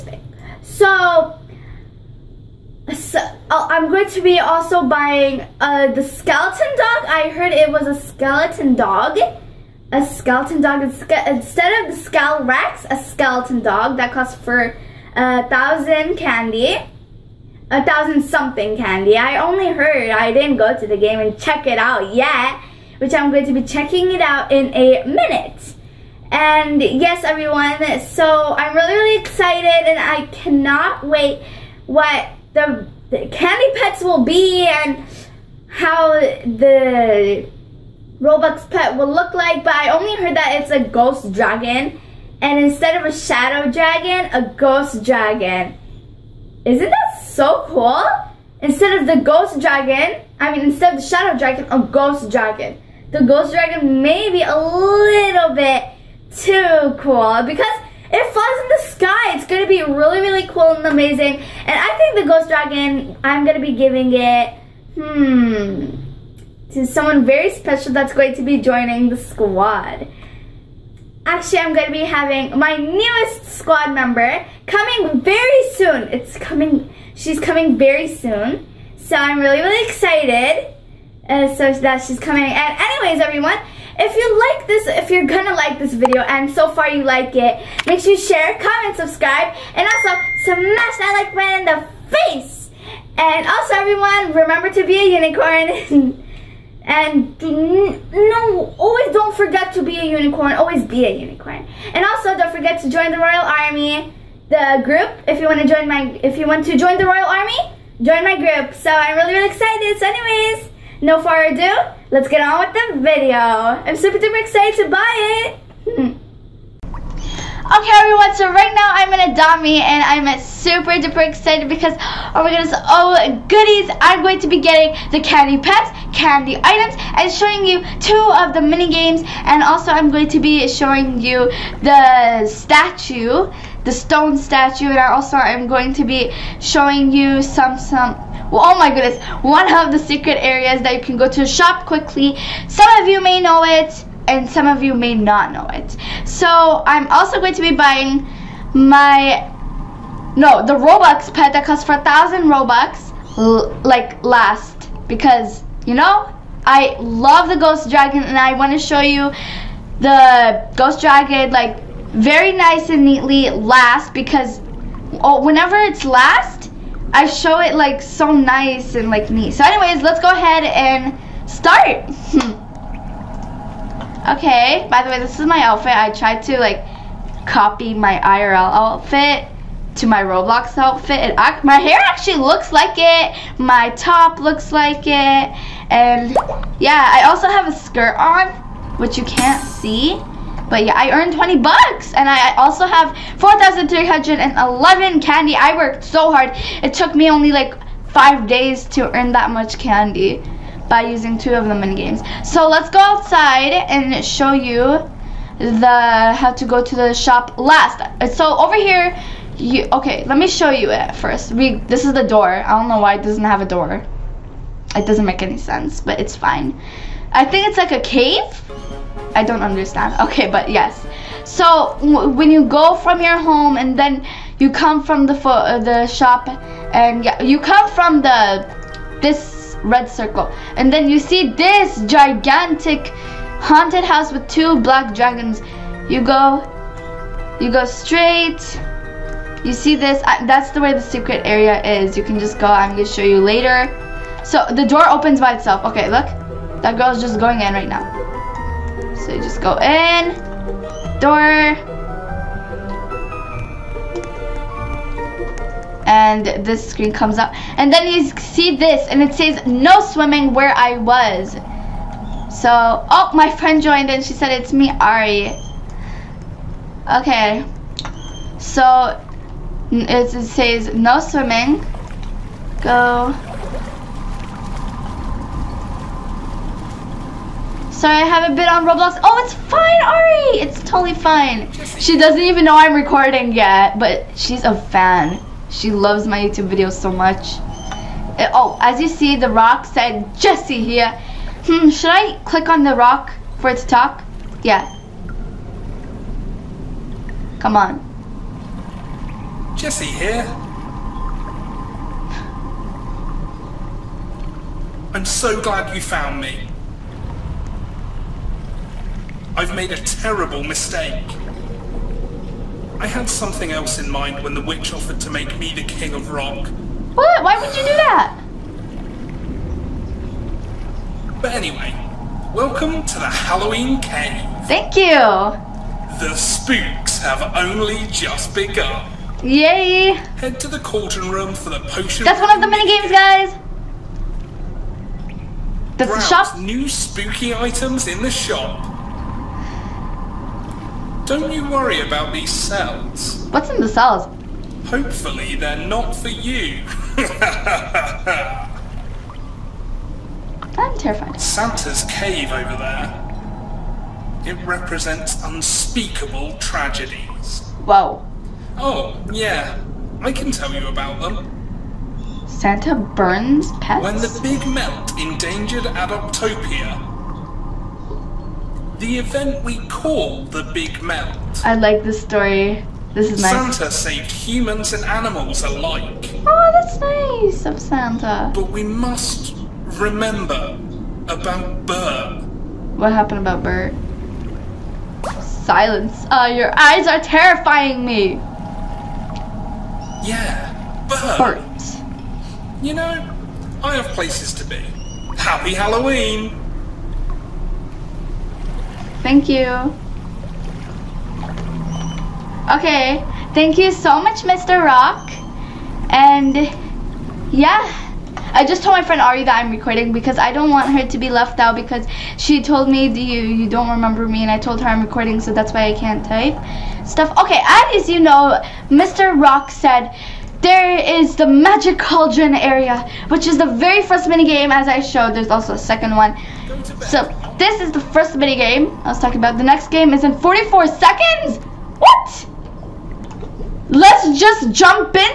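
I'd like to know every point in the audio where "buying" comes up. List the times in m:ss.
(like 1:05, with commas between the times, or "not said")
0:04, 2:27.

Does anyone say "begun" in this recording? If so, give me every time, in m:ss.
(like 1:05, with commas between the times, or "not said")
5:28.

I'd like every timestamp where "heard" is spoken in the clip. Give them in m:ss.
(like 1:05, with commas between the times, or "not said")
0:07, 0:19, 0:40.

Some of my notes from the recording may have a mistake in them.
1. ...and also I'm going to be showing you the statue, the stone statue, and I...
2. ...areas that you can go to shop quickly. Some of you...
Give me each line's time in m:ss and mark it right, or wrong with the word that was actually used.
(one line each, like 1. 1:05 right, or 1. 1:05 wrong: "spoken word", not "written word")
1. 2:09 right
2. 2:20 right.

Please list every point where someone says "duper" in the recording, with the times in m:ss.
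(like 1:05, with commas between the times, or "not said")
1:54, 2:00.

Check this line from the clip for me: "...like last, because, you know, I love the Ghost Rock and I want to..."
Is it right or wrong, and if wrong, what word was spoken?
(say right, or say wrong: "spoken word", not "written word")
wrong: "Dragon", not "Rock".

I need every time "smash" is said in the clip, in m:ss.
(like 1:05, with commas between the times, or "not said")
1:30.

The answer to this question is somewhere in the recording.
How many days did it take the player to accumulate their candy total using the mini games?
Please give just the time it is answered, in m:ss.
3:18.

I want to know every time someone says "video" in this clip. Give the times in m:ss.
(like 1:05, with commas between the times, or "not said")
1:25, 1:53, 4:46.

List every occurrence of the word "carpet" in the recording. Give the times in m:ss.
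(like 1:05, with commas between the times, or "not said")
not said.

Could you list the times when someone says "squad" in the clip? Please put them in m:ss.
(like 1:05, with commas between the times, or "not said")
1:09, 1:13.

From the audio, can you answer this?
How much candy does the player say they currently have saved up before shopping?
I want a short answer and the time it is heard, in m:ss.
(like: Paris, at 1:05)
4,311, at 3:13.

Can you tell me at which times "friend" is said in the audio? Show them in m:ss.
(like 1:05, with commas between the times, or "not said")
4:23, 6:49.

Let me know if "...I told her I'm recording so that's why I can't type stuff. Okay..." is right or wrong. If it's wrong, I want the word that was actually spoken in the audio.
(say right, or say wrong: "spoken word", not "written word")
right.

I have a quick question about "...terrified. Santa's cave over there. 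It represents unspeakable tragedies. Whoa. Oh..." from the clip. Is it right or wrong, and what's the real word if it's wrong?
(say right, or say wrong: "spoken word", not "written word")
right.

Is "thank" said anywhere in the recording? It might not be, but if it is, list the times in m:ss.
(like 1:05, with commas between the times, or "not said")
5:24, 6:39, 6:43.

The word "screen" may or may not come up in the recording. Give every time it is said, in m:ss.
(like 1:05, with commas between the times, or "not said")
4:16.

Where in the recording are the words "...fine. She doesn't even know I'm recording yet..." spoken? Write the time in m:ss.
4:41.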